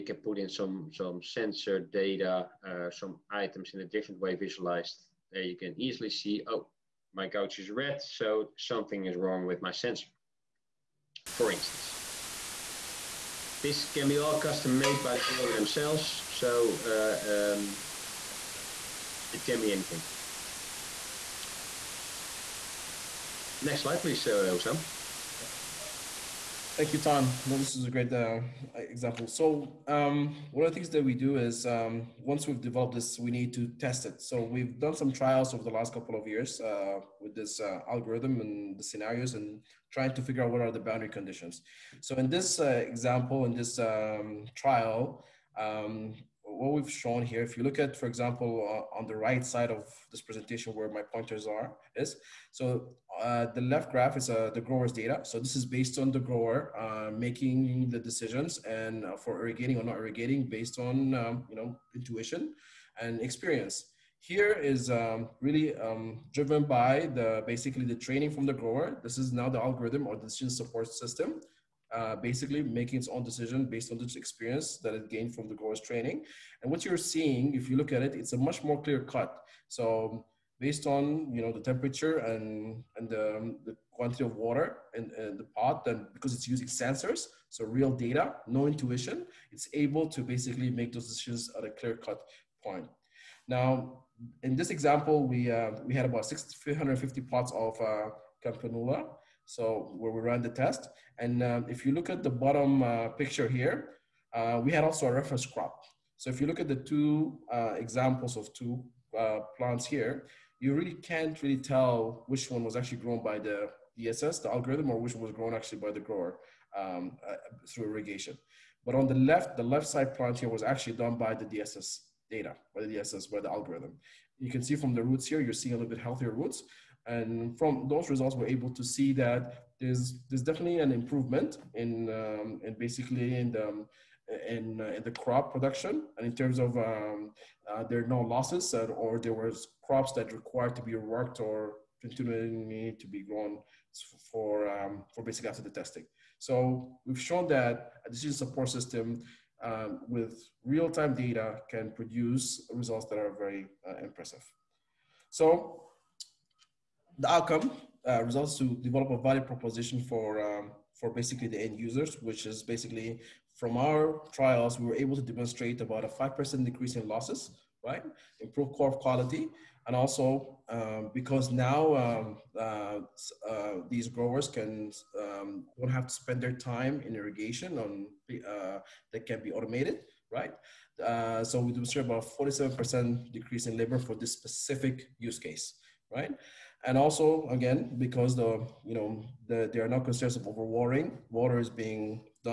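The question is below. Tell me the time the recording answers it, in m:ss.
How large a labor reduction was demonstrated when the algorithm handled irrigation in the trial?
3:02.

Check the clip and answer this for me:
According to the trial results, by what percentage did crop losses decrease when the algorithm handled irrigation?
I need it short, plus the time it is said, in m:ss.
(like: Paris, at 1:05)
5%, at 2:46.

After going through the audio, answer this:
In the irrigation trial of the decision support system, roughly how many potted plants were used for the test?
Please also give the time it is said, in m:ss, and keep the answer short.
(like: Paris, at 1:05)
650, at 1:36.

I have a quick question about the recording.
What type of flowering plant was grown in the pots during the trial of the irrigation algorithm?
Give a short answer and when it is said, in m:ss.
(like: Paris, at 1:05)
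Campanula, at 1:38.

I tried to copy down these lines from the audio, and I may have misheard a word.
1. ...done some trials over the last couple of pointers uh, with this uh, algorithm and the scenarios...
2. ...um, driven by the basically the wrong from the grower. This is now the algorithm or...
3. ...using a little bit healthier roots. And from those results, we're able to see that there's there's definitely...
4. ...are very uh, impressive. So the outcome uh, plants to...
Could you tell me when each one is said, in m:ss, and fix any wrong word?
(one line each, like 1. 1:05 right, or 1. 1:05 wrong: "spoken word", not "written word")
1. 0:34 wrong: "years", not "pointers"
2. 1:05 wrong: "training", not "wrong"
3. 2:05 wrong: "seeing", not "using"
4. 2:33 wrong: "results", not "plants".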